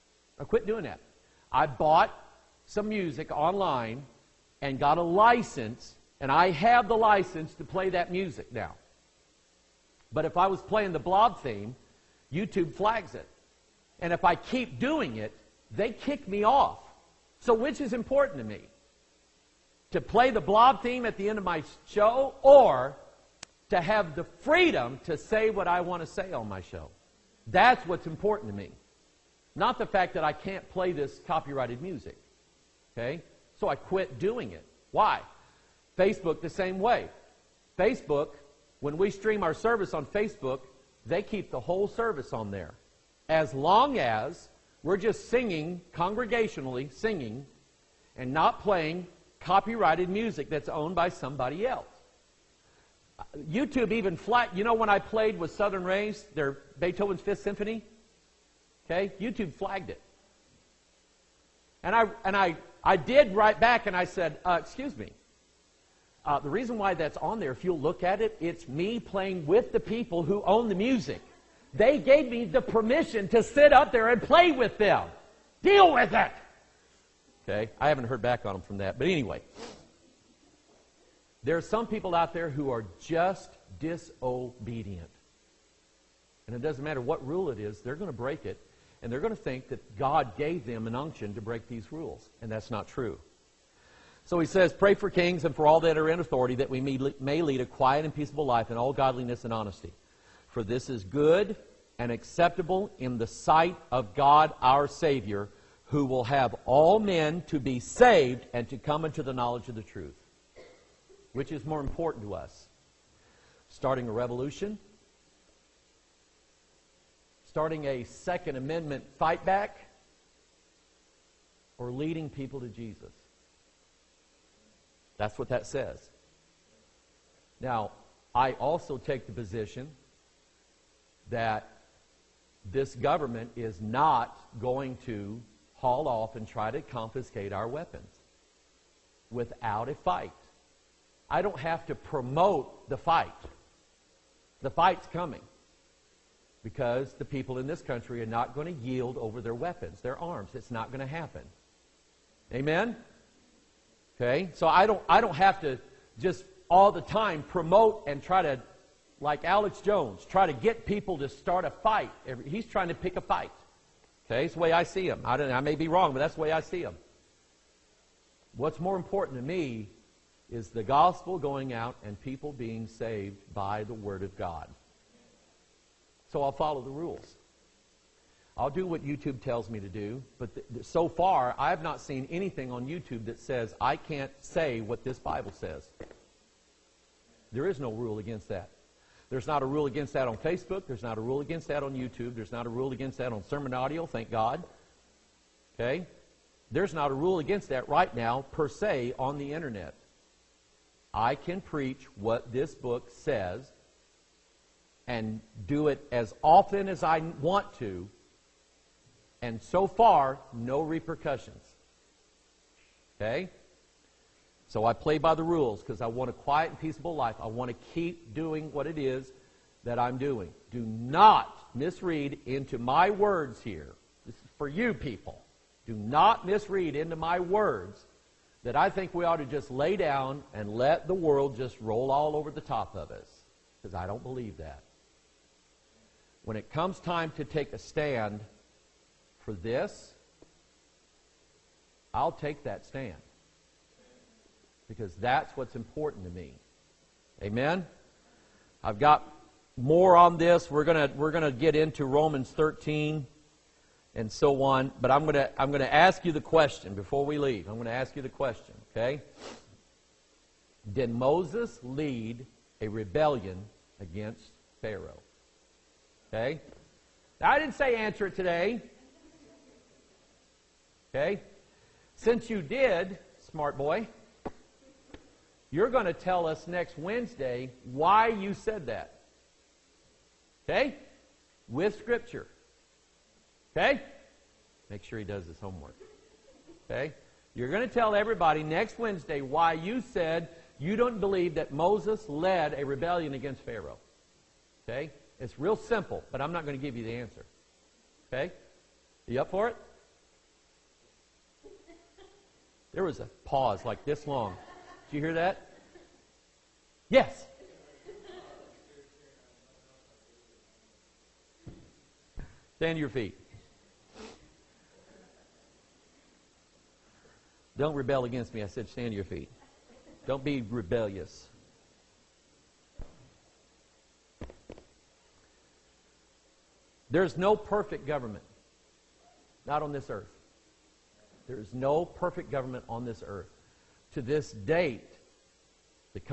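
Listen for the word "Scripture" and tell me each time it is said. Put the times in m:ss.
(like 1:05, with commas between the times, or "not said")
4:41.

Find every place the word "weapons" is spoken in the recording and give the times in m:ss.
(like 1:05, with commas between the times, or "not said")
2:17, 2:29.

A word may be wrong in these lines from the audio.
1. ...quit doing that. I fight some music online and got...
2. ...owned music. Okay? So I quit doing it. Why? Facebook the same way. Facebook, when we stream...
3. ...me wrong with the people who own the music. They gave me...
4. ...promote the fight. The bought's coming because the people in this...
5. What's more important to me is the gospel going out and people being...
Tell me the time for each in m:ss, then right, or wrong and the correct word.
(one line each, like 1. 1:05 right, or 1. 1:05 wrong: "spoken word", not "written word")
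1. 0:00 wrong: "bought", not "fight"
2. 0:31 wrong: "copyrighted", not "owned"
3. 1:08 wrong: "playing", not "wrong"
4. 2:21 wrong: "fight", not "bought"
5. 2:48 right.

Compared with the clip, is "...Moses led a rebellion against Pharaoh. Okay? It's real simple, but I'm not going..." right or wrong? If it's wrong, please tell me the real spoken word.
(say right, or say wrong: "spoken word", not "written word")
right.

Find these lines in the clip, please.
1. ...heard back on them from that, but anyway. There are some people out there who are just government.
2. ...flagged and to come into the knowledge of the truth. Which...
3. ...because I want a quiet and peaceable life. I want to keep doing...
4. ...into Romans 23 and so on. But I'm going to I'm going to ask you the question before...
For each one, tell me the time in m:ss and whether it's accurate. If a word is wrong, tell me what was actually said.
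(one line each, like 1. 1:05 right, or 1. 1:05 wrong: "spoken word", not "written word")
1. 1:18 wrong: "disobedient", not "government"
2. 1:47 wrong: "saved", not "flagged"
3. 3:35 right
4. 4:11 wrong: "13", not "23".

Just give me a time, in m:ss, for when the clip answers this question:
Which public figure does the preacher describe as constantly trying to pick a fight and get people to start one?
2:39.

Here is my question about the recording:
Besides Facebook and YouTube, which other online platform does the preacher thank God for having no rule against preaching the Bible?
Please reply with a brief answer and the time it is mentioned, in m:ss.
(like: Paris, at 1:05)
Sermon Audio, at 3:13.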